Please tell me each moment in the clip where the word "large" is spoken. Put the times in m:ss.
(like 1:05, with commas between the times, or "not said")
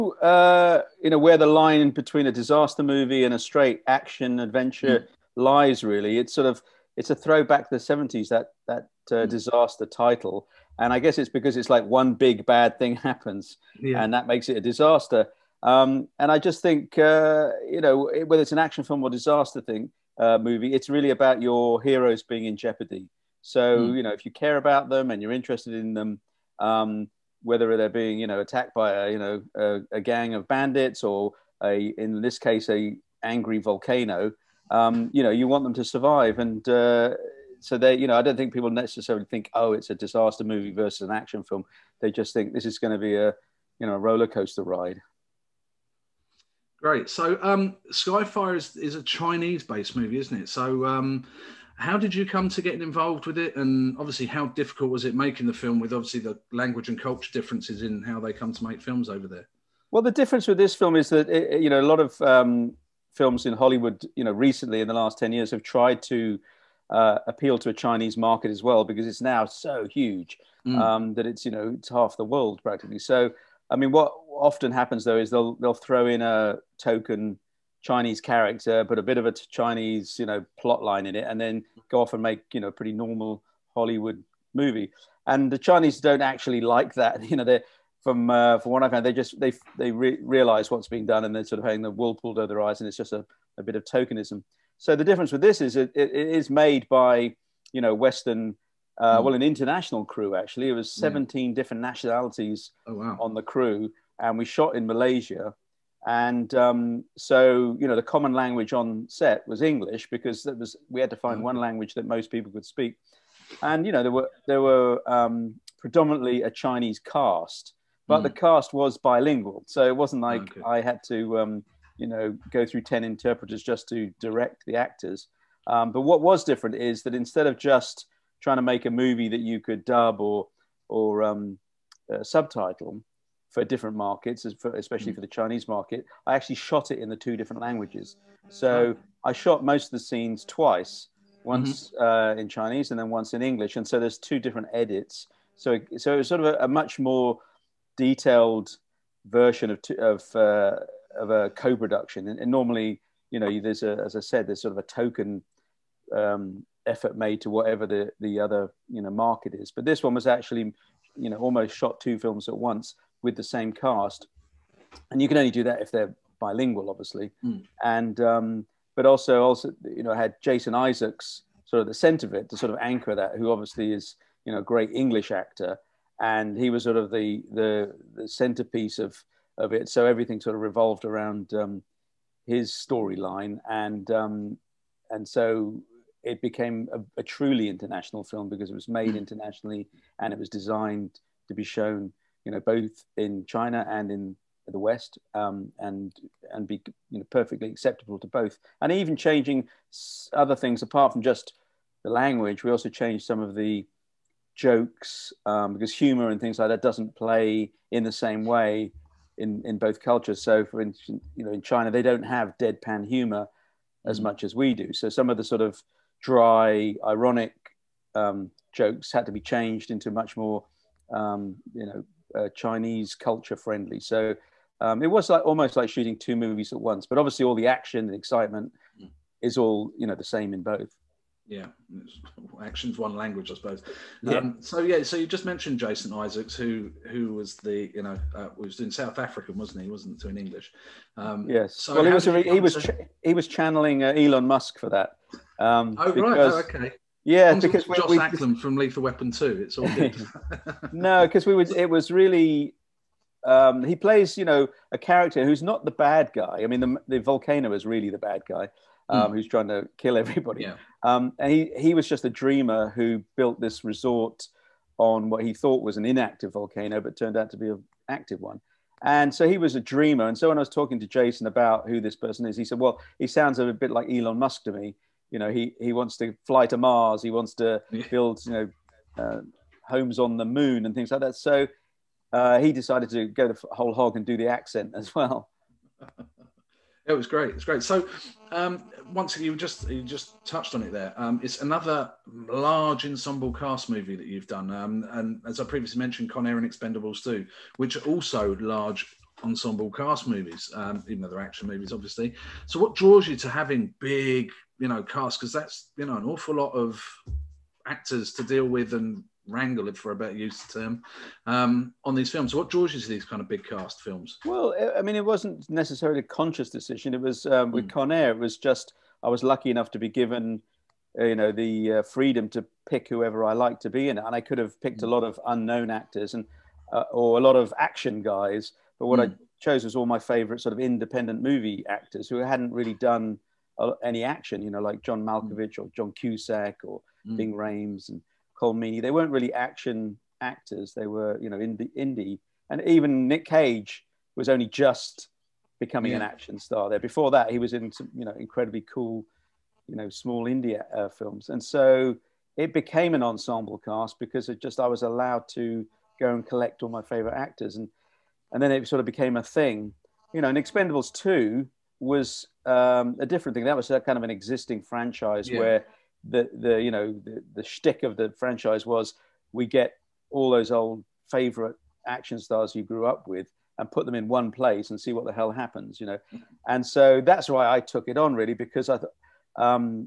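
4:52, 4:58.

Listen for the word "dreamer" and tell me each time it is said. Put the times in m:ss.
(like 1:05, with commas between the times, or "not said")
4:22, 4:29.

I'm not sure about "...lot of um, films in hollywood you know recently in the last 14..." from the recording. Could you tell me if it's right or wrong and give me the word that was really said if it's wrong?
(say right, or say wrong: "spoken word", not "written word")
wrong: "10", not "14".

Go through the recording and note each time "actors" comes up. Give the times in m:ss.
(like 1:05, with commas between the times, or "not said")
2:04, 2:55, 5:07, 5:25, 5:31, 5:40, 5:57.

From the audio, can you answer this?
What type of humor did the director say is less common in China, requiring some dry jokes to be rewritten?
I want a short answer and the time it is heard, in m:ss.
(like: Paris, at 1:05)
Deadpan humor, at 3:32.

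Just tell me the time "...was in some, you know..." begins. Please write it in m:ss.
5:47.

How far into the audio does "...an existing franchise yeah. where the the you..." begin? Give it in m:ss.
6:04.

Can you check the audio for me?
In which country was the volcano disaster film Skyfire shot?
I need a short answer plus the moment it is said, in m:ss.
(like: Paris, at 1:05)
Malaysia, at 1:44.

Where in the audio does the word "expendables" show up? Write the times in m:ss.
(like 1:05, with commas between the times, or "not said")
4:56, 6:00.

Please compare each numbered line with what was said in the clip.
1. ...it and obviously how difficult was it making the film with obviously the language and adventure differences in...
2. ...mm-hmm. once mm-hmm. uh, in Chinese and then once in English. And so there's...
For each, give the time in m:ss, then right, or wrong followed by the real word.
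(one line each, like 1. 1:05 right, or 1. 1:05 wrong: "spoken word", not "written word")
1. 0:53 wrong: "culture", not "adventure"
2. 2:21 right.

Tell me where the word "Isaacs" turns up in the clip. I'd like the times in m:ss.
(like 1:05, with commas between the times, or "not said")
2:50, 3:56.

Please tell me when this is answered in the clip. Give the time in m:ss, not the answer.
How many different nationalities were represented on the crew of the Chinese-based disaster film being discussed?
1:41.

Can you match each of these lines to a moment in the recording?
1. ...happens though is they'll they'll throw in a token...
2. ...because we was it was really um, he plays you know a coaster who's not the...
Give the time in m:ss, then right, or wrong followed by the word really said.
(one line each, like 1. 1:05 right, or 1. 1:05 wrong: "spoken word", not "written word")
1. 1:14 right
2. 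4:11 wrong: "character", not "coaster".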